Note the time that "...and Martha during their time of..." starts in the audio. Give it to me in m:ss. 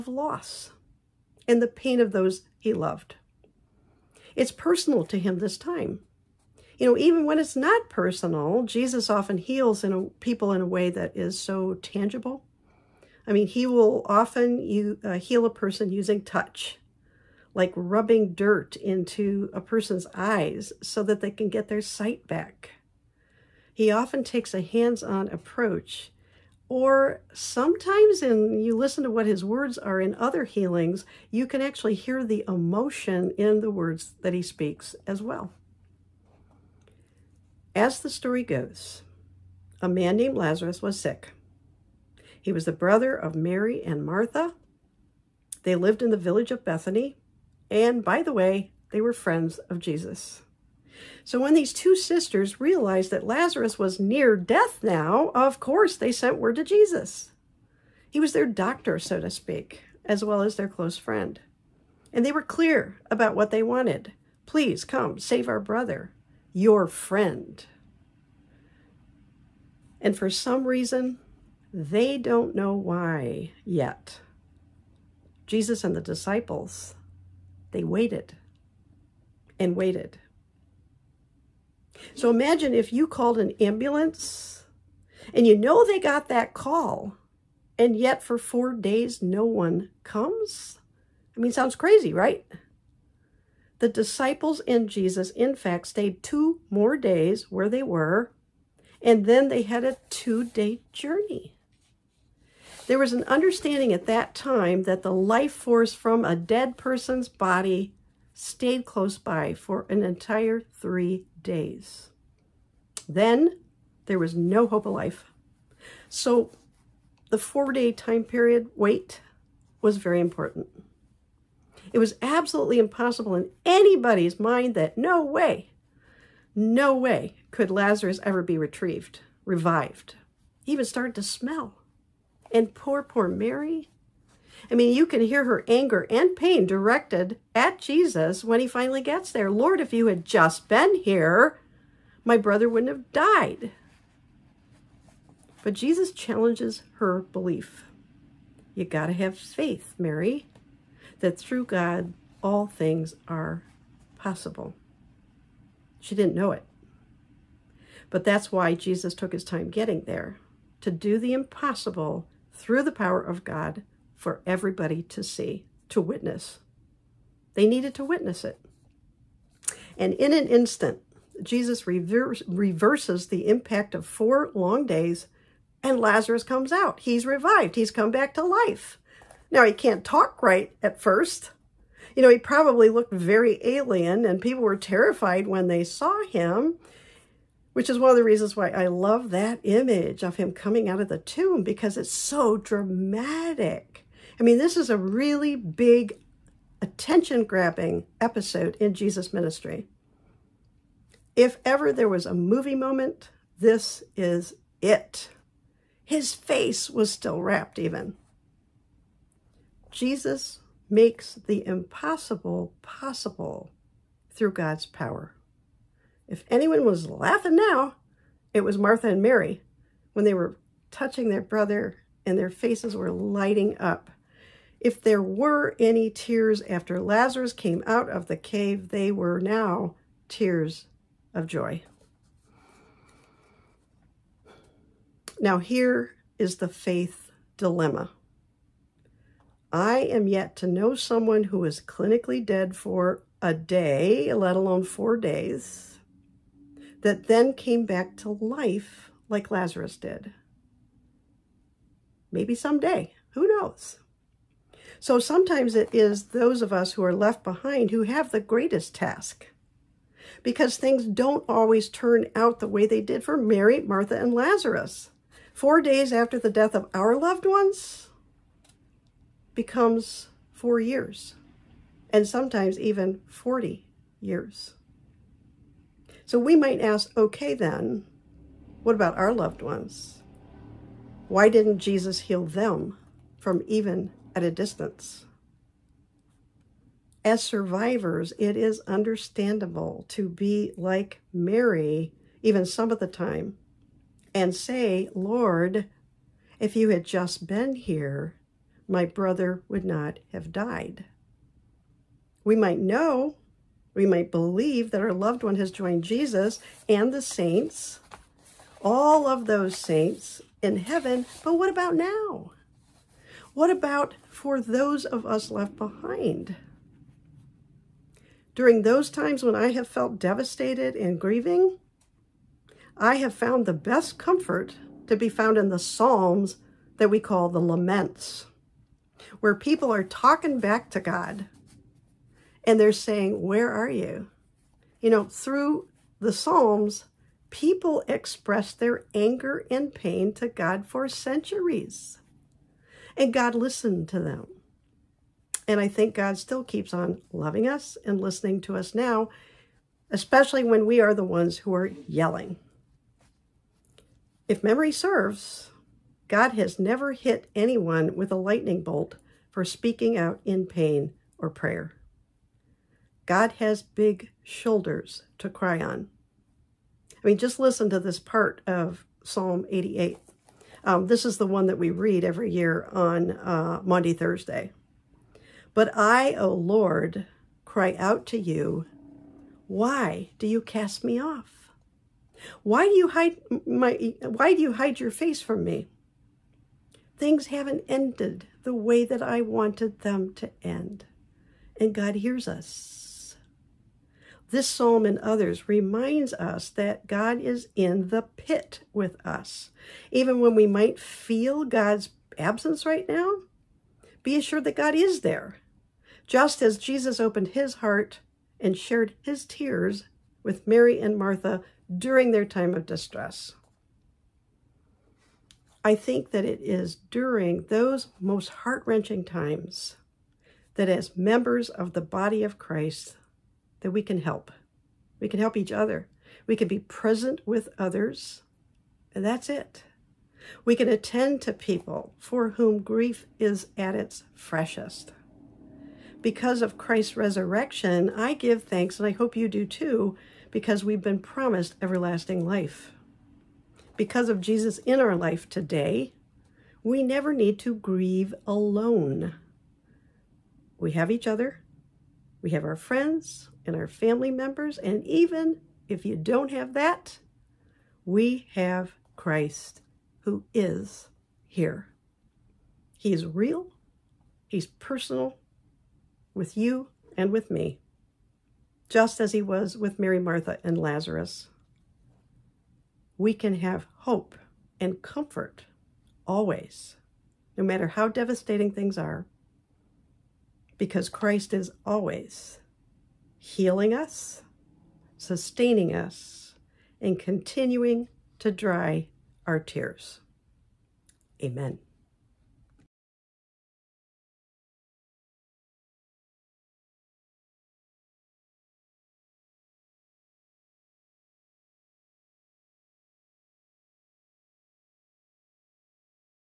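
6:51.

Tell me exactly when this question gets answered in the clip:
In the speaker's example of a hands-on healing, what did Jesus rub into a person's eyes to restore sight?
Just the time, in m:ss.
0:18.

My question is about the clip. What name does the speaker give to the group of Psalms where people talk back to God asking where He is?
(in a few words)
The Laments.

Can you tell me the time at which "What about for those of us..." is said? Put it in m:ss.
5:13.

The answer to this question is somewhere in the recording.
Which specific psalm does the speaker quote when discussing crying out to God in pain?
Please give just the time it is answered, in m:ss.
6:09.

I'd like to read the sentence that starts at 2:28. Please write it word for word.
You got to have faith, Mary, that through God, all things are possible.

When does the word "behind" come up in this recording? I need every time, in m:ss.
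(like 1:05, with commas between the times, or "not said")
4:17, 5:15.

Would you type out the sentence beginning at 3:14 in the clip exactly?
I mean, this is a really big, attention grabbing episode in Jesus' ministry.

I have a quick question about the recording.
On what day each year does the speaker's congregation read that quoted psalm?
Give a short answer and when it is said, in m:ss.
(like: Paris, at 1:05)
Maundy Thursday, at 6:13.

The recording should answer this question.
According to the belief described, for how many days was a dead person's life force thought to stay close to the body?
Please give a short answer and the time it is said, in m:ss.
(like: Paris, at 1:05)
3, at 1:50.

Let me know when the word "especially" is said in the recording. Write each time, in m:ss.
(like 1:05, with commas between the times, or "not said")
5:50.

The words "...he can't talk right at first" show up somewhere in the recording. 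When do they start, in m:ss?
2:59.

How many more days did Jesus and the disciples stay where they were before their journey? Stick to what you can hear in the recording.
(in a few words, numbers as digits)
2.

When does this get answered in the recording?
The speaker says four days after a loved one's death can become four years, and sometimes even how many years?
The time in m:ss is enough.
4:33.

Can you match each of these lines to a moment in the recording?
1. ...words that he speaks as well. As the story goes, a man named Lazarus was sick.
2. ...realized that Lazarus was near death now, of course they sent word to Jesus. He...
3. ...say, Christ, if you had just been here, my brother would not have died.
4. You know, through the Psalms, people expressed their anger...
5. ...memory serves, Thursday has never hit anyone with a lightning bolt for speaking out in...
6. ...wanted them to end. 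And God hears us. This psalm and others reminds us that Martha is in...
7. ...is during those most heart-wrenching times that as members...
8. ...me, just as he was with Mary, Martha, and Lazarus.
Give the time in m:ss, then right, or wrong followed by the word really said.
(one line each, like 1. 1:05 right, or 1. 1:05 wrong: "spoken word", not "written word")
1. 0:33 right
2. 0:52 right
3. 4:54 wrong: "Lord", not "Christ"
4. 5:35 right
5. 5:54 wrong: "God", not "Thursday"
6. 6:29 wrong: "God", not "Martha"
7. 6:56 right
8. 7:47 right.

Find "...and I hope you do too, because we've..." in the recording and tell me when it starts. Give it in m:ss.
7:18.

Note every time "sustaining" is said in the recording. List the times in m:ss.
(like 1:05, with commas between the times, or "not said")
8:05.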